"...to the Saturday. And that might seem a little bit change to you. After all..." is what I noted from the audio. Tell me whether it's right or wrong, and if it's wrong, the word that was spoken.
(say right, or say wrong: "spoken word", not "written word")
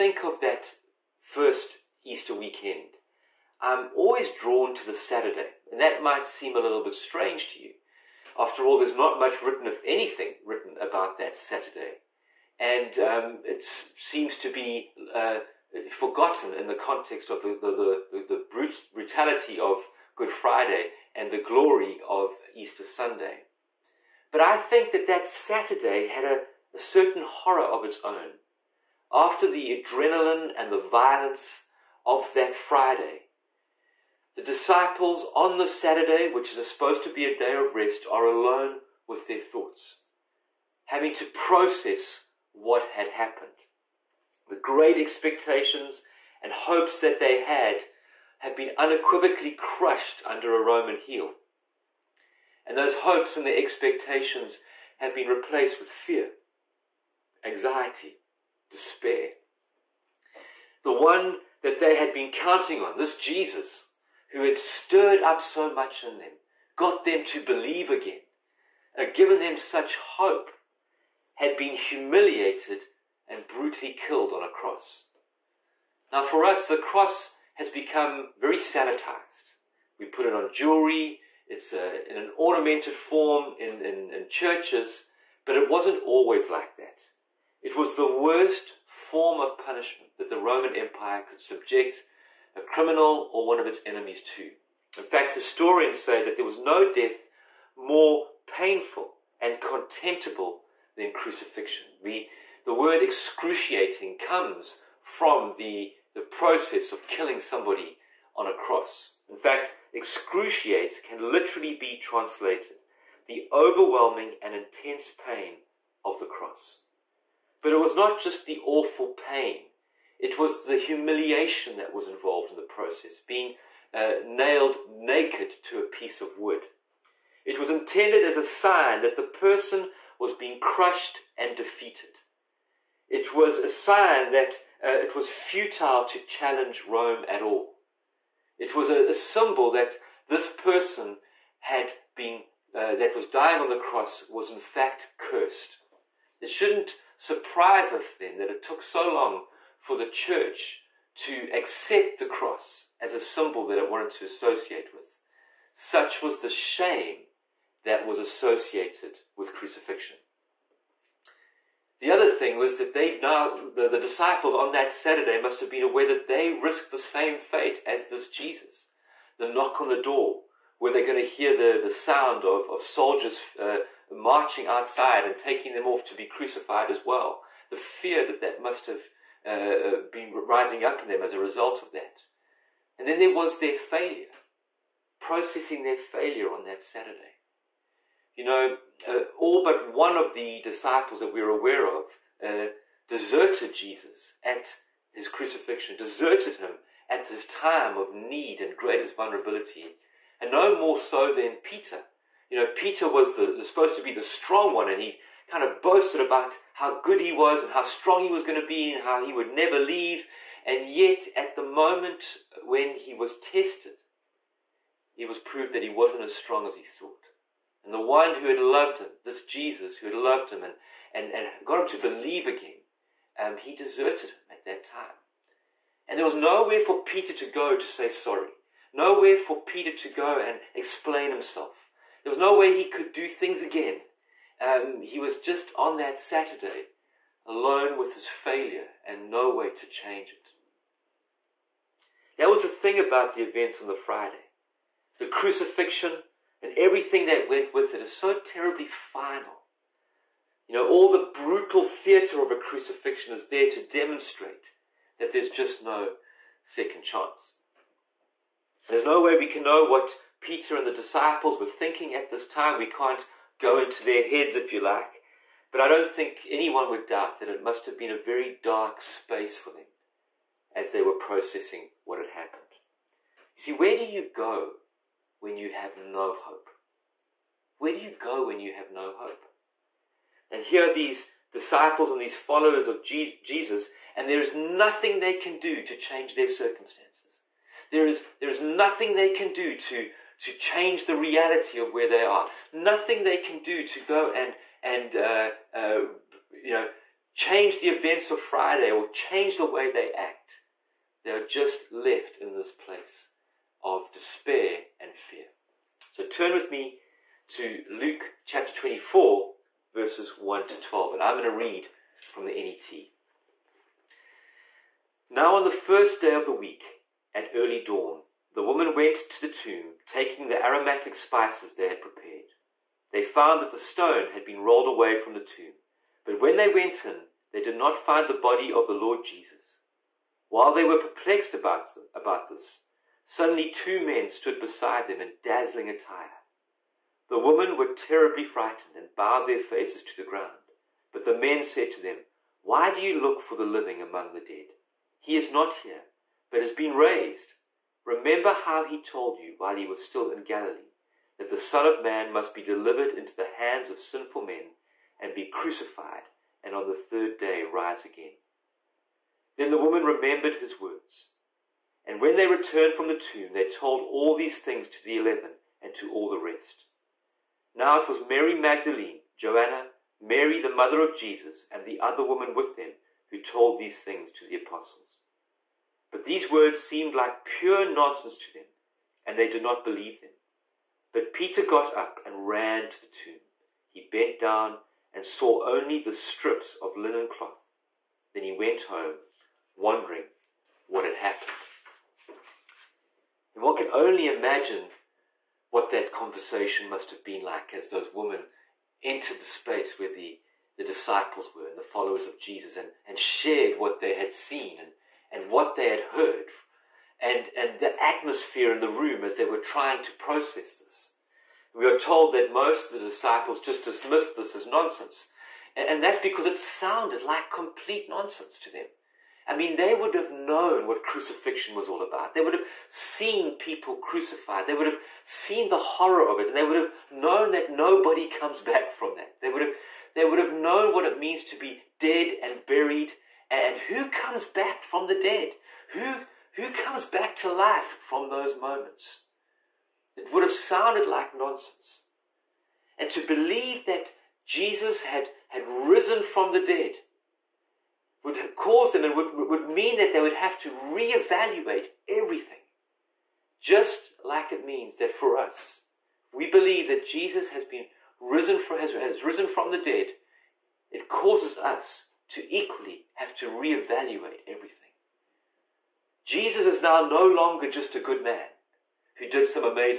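wrong: "strange", not "change".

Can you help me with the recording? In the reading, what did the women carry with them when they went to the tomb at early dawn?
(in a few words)
aromatic spices.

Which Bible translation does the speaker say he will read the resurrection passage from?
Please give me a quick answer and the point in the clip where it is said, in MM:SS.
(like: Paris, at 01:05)
NET, at 05:12.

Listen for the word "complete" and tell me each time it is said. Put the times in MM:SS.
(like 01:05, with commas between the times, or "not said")
06:57.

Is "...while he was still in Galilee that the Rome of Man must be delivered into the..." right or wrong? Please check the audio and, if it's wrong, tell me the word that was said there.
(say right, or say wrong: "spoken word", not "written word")
wrong: "Son", not "Rome".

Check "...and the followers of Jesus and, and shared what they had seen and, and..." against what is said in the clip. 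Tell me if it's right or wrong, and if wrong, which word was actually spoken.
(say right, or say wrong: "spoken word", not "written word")
right.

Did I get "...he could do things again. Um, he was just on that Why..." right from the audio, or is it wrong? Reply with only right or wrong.
wrong.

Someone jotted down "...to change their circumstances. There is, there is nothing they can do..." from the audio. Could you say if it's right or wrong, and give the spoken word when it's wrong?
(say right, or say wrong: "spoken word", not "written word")
right.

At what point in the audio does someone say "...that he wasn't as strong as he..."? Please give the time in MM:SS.
03:35.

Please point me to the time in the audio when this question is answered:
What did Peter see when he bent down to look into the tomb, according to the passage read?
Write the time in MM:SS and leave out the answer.
06:26.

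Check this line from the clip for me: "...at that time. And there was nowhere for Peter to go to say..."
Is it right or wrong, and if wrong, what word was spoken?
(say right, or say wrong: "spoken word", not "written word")
right.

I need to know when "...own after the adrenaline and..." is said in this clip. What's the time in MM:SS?
00:28.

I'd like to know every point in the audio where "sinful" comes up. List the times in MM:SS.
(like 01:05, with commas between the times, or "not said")
05:53.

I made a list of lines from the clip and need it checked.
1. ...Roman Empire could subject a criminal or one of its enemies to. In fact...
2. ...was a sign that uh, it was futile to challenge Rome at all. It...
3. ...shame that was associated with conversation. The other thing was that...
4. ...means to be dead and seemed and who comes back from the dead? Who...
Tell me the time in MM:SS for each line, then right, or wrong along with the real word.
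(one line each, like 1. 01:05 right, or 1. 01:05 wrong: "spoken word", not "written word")
1. 01:30 right
2. 02:13 right
3. 02:36 wrong: "crucifixion", not "conversation"
4. 07:11 wrong: "buried", not "seemed".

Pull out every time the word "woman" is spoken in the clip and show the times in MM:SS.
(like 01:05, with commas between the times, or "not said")
05:18, 05:59, 06:12.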